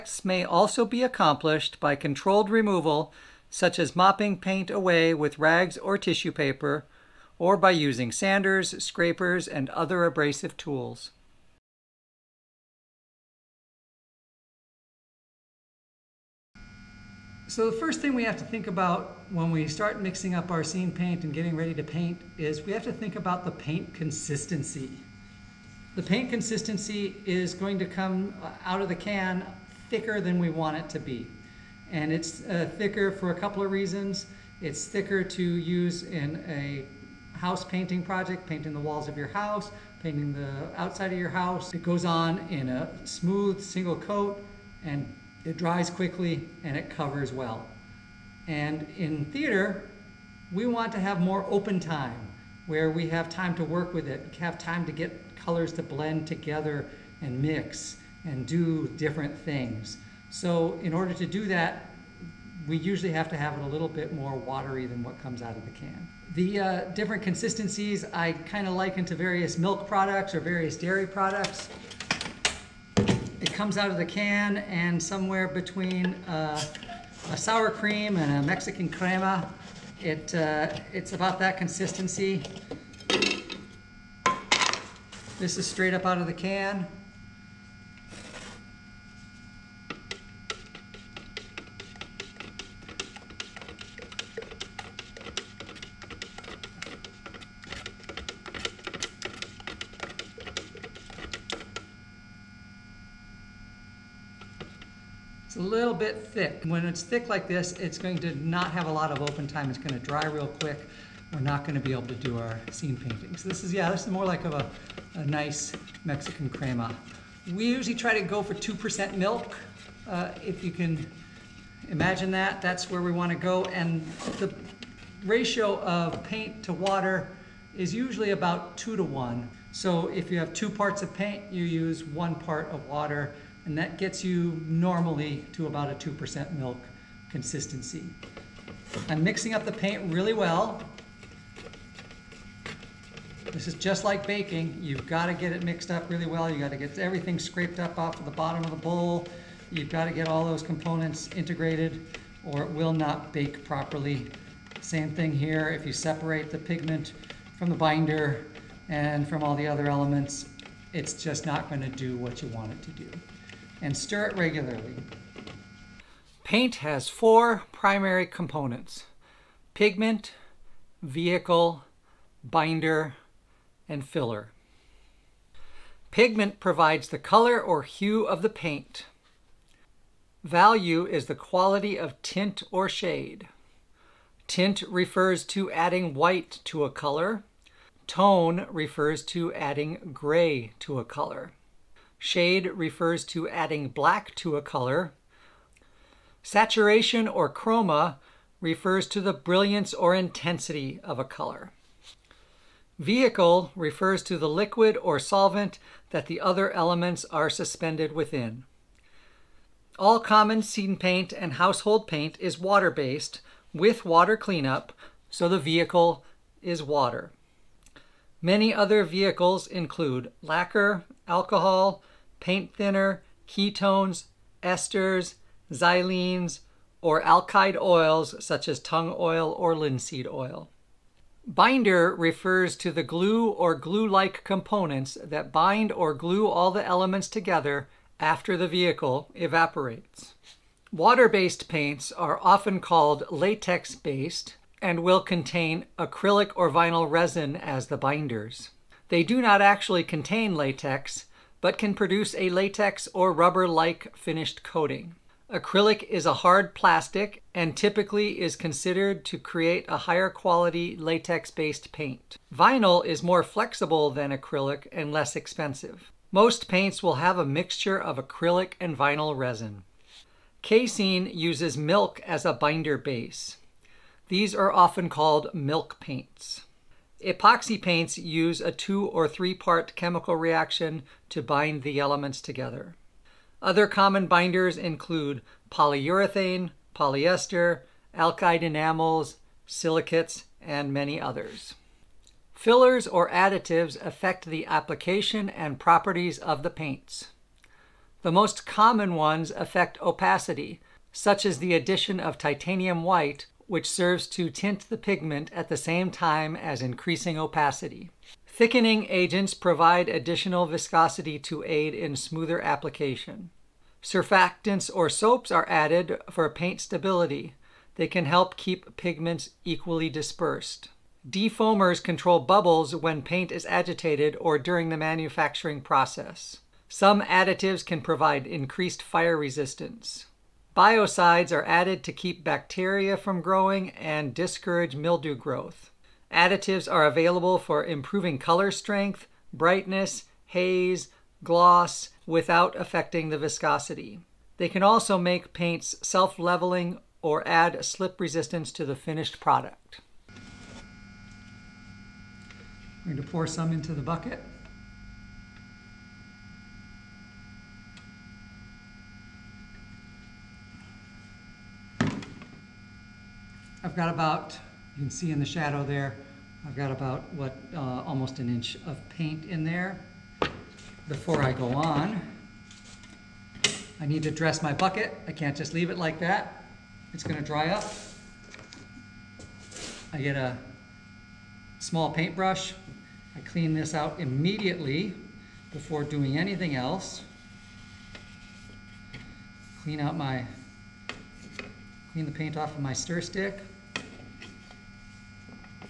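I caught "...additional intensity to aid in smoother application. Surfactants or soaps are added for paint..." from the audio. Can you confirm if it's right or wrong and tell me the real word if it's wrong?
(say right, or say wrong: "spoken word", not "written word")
wrong: "viscosity", not "intensity".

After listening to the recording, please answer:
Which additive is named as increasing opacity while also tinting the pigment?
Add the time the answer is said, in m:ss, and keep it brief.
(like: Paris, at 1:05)
Titanium white, at 5:02.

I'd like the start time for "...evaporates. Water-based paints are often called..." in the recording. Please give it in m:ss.
3:59.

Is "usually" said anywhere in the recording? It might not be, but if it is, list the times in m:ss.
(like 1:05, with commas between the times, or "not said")
1:02, 1:57, 2:07.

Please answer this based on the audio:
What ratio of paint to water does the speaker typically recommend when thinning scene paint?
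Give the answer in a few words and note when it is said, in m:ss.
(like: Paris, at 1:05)
2 to 1, at 2:08.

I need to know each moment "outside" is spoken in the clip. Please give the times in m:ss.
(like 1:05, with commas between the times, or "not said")
0:40.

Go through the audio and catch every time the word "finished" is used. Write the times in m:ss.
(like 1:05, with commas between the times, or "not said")
4:14, 5:48.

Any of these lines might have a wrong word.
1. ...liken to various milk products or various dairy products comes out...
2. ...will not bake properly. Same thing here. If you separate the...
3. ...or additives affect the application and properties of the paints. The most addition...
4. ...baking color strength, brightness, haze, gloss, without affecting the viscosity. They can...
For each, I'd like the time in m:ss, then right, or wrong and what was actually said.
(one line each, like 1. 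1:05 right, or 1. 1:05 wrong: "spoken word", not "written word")
1. 1:08 right
2. 2:32 right
3. 4:53 wrong: "common", not "addition"
4. 5:37 wrong: "improving", not "baking".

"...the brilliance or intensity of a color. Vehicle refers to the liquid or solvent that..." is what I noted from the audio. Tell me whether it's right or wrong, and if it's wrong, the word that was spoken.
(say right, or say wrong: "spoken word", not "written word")
right.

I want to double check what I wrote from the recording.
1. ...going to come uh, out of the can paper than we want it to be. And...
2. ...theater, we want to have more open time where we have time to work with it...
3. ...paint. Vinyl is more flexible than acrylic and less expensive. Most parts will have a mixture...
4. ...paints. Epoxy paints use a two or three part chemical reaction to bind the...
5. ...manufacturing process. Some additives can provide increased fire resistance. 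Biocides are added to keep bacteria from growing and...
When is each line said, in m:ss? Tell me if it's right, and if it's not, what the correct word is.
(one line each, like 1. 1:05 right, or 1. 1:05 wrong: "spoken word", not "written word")
1. 0:27 wrong: "thicker", not "paper"
2. 0:49 right
3. 4:21 wrong: "paints", not "parts"
4. 4:35 right
5. 5:24 right.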